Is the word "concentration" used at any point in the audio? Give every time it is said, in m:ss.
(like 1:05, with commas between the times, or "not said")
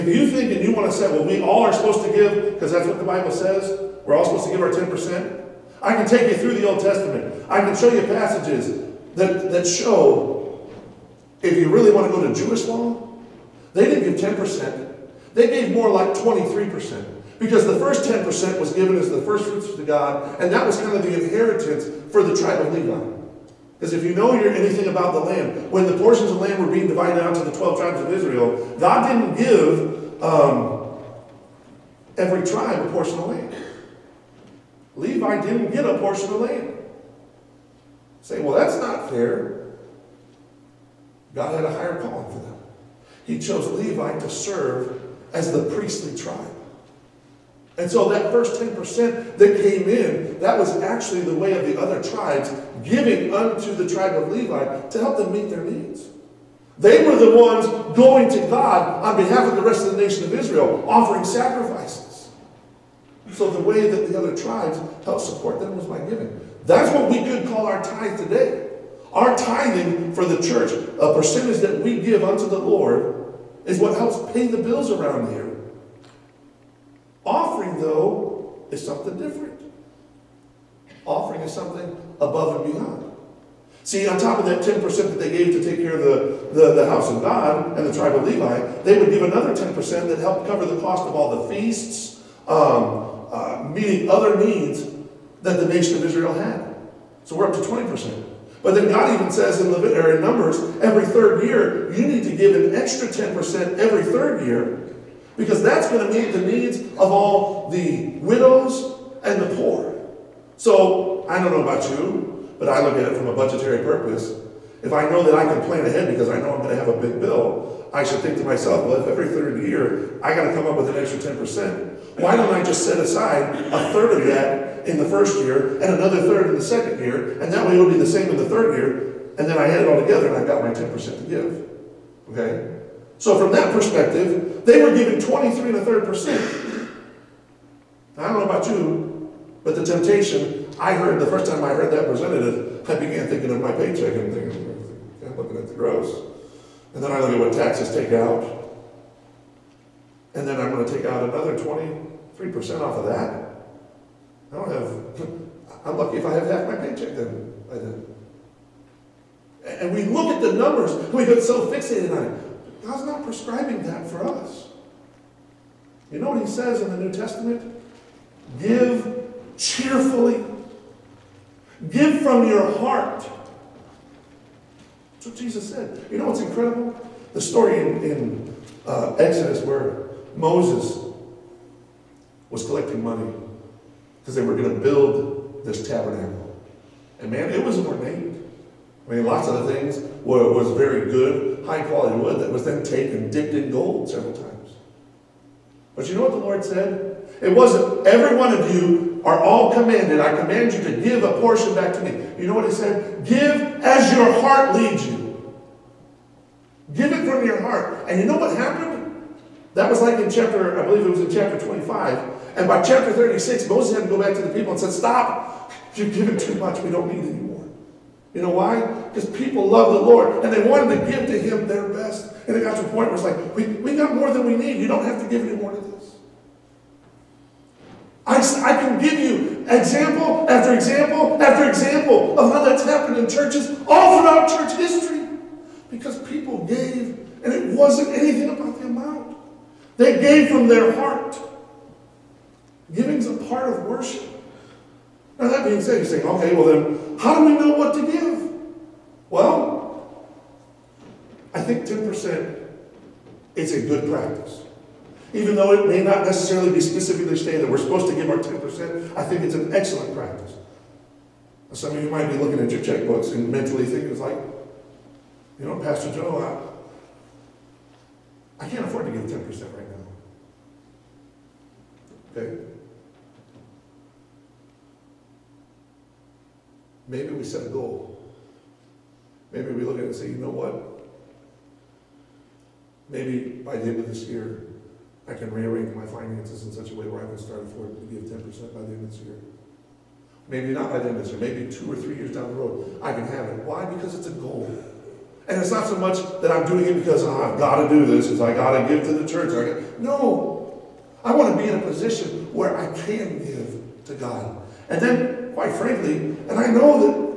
not said.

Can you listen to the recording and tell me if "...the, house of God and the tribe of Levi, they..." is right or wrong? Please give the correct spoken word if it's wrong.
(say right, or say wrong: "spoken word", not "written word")
right.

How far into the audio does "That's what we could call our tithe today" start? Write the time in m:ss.
1:06.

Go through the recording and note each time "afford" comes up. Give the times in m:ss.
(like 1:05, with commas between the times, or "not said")
4:28, 4:47.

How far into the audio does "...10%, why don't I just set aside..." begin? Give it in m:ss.
2:01.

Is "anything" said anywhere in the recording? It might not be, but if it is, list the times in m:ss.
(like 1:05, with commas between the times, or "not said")
0:24, 3:58.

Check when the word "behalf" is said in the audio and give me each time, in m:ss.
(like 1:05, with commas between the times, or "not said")
0:59.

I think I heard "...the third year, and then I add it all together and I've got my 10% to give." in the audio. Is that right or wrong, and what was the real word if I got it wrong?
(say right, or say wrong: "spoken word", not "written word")
right.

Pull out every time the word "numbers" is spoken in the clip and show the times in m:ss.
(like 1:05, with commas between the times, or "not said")
1:40, 2:40.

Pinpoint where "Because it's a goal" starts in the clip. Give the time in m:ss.
4:53.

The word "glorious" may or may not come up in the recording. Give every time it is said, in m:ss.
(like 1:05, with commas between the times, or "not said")
not said.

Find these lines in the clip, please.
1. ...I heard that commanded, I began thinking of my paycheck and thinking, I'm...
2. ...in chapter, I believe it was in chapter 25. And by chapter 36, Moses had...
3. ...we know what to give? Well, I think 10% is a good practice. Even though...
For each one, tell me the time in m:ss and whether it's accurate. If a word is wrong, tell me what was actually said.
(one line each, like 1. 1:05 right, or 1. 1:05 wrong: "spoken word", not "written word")
1. 2:21 wrong: "presented", not "commanded"
2. 3:30 right
3. 4:07 right.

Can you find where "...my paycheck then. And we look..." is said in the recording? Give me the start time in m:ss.
2:36.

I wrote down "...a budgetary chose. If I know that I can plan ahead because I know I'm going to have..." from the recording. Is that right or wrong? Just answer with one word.
wrong.